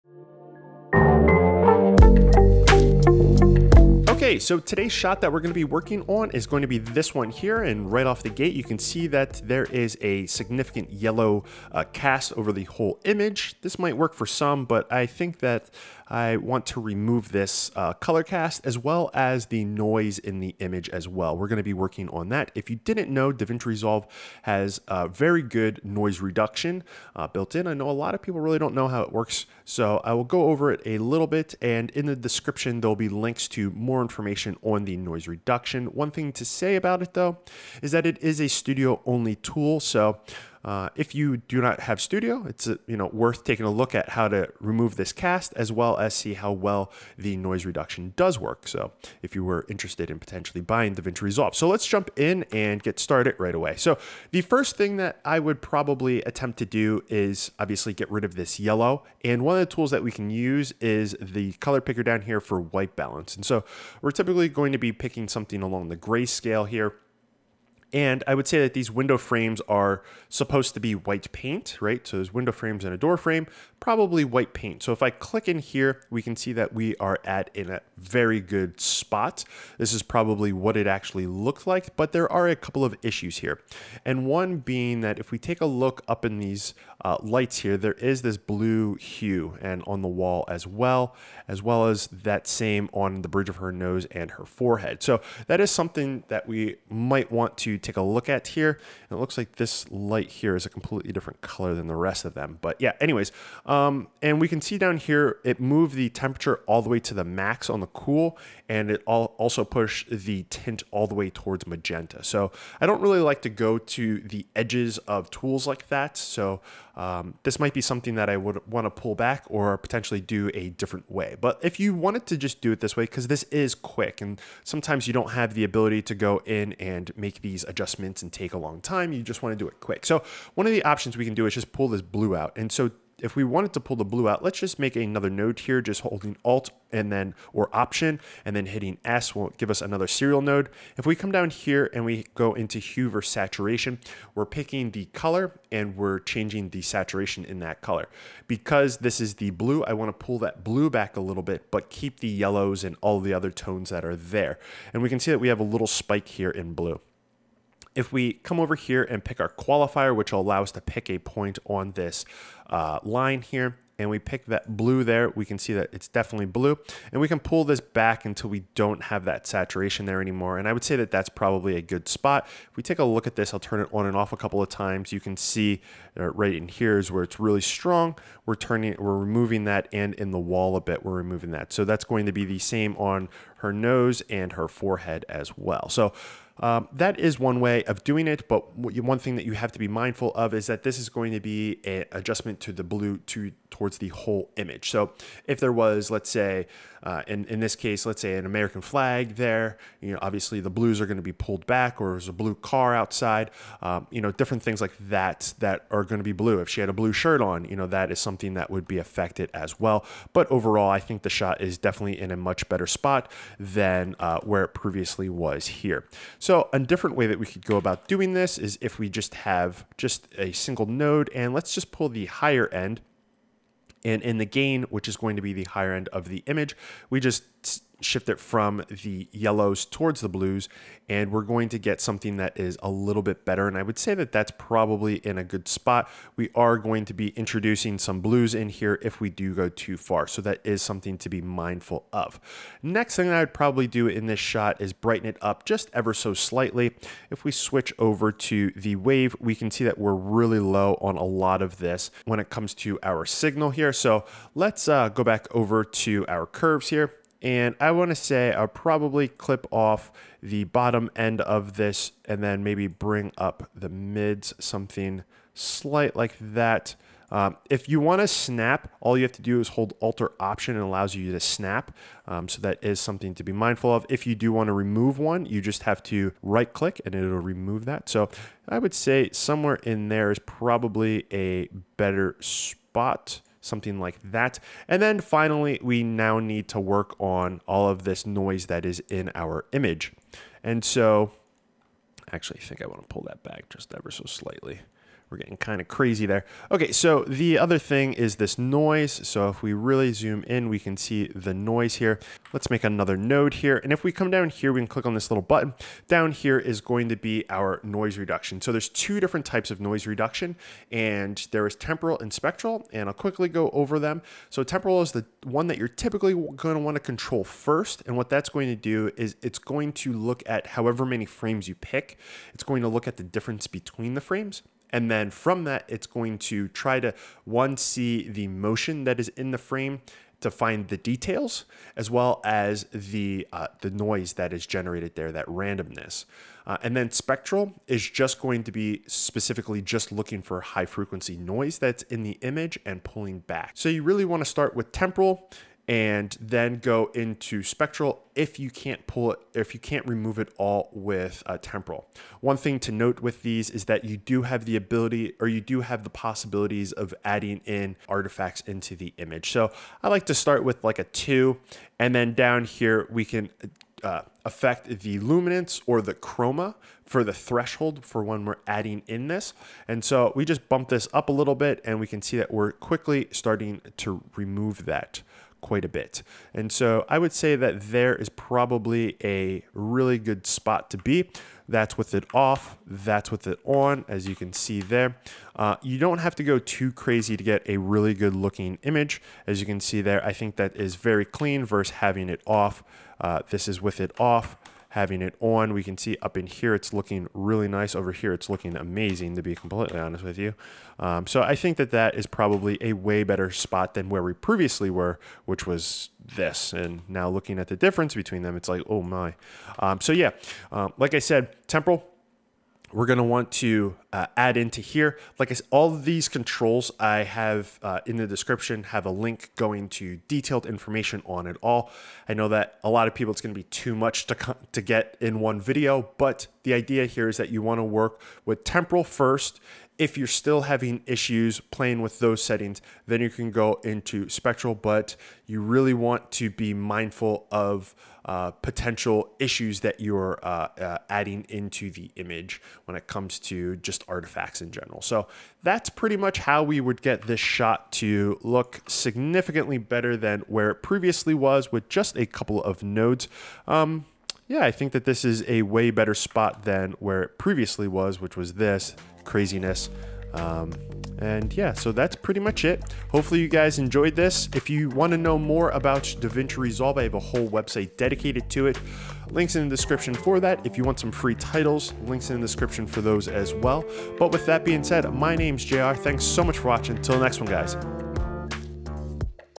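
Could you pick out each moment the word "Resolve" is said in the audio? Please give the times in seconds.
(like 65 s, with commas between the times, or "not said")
23 s, 51 s, 466 s.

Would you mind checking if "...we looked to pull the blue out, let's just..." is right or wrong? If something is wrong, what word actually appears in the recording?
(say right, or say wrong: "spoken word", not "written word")
wrong: "wanted", not "looked".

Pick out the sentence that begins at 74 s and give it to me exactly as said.
So if I click in here, we can see that we are at in a very good spot.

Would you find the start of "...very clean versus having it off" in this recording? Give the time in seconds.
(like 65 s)
390 s.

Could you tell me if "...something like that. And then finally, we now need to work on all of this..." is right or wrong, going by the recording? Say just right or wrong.
right.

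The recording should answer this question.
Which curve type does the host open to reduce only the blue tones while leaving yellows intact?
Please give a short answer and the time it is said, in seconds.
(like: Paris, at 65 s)
Hue versus Saturation, at 142 s.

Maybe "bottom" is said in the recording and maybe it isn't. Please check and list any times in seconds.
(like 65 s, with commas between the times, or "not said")
260 s.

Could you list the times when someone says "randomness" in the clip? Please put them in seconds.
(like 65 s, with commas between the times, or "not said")
335 s.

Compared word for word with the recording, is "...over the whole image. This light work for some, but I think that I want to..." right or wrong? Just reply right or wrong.
wrong.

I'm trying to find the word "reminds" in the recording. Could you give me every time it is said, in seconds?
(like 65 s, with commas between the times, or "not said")
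not said.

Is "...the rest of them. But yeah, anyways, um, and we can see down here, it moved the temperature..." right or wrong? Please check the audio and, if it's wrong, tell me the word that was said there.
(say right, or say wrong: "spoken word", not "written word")
right.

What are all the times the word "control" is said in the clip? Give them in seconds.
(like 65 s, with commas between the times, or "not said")
317 s, 416 s.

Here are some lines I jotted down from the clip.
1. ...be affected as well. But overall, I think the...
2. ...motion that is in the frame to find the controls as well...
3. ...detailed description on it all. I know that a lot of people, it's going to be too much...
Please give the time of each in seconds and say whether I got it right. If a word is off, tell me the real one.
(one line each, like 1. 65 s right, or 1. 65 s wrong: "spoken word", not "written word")
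1. 208 s right
2. 328 s wrong: "details", not "controls"
3. 420 s wrong: "information", not "description".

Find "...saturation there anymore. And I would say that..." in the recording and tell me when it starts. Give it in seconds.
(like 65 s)
169 s.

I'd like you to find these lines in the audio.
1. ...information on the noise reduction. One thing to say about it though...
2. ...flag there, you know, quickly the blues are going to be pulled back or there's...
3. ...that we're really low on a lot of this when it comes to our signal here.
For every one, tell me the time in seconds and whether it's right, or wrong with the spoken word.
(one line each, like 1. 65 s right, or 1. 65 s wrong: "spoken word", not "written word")
1. 34 s right
2. 198 s wrong: "obviously", not "quickly"
3. 249 s right.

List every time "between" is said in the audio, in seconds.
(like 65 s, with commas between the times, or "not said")
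323 s, 408 s.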